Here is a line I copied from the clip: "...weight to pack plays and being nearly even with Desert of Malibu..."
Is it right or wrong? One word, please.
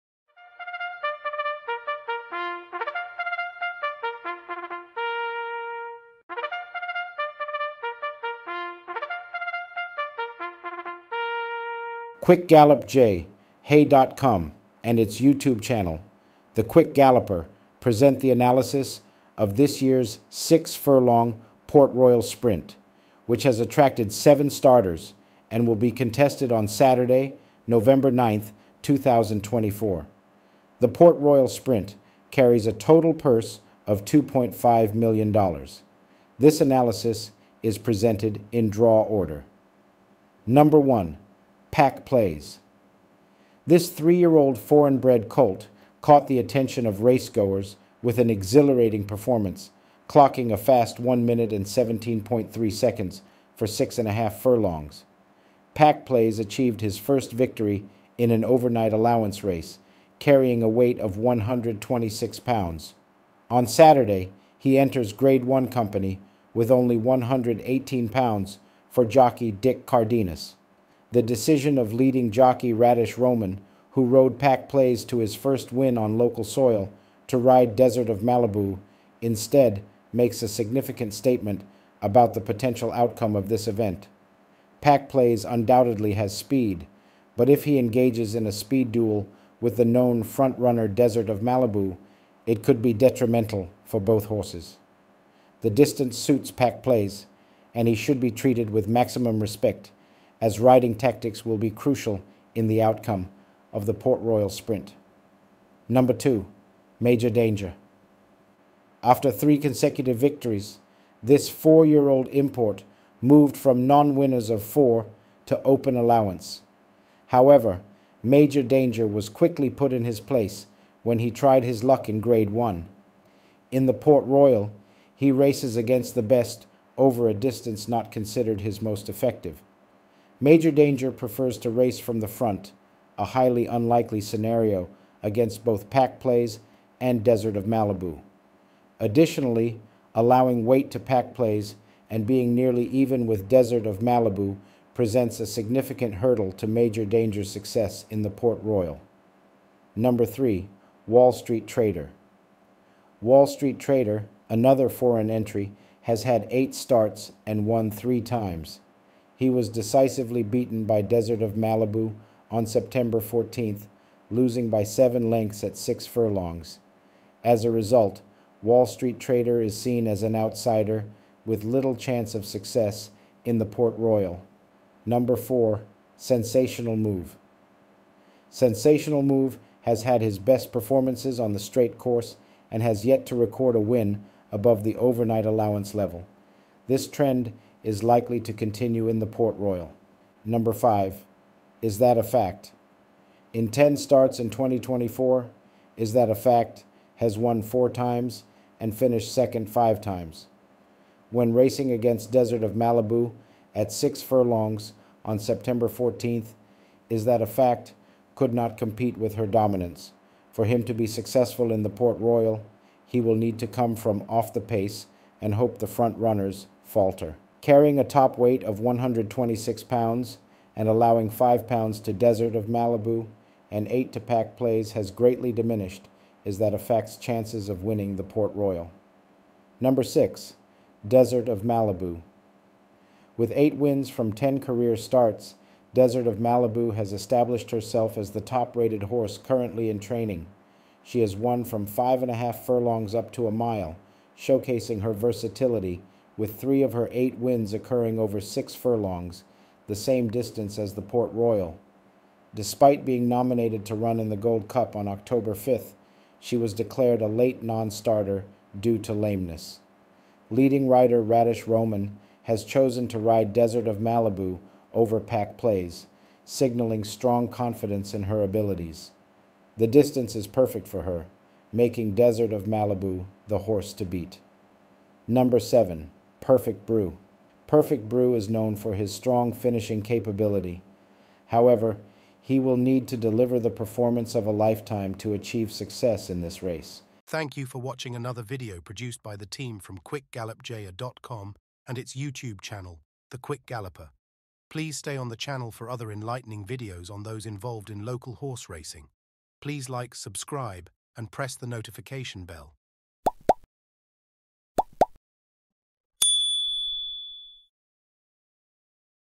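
right.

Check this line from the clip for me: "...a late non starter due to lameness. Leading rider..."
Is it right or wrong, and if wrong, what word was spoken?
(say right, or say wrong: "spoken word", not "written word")
right.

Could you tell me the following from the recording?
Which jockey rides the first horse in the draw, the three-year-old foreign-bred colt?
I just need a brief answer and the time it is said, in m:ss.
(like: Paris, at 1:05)
Dick Cardenas, at 1:09.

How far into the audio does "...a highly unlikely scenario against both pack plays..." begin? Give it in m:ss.
2:13.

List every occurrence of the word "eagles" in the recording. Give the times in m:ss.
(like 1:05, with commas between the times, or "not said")
not said.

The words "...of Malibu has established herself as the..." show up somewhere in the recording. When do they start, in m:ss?
3:56.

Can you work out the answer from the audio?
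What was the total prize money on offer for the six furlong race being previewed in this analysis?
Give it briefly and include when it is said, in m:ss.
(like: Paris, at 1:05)
$2.5 million, at 0:34.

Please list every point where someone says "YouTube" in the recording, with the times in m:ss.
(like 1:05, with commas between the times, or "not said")
0:15, 4:52.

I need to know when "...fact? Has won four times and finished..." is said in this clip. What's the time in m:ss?
3:16.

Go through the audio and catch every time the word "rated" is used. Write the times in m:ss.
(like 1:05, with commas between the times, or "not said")
3:58.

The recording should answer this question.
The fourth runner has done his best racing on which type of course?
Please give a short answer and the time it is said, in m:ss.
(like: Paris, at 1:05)
straight course, at 3:01.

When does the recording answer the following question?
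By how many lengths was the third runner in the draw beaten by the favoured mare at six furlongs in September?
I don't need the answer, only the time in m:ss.
2:44.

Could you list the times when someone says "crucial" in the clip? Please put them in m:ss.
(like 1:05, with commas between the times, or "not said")
1:41.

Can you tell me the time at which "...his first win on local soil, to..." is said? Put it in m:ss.
1:15.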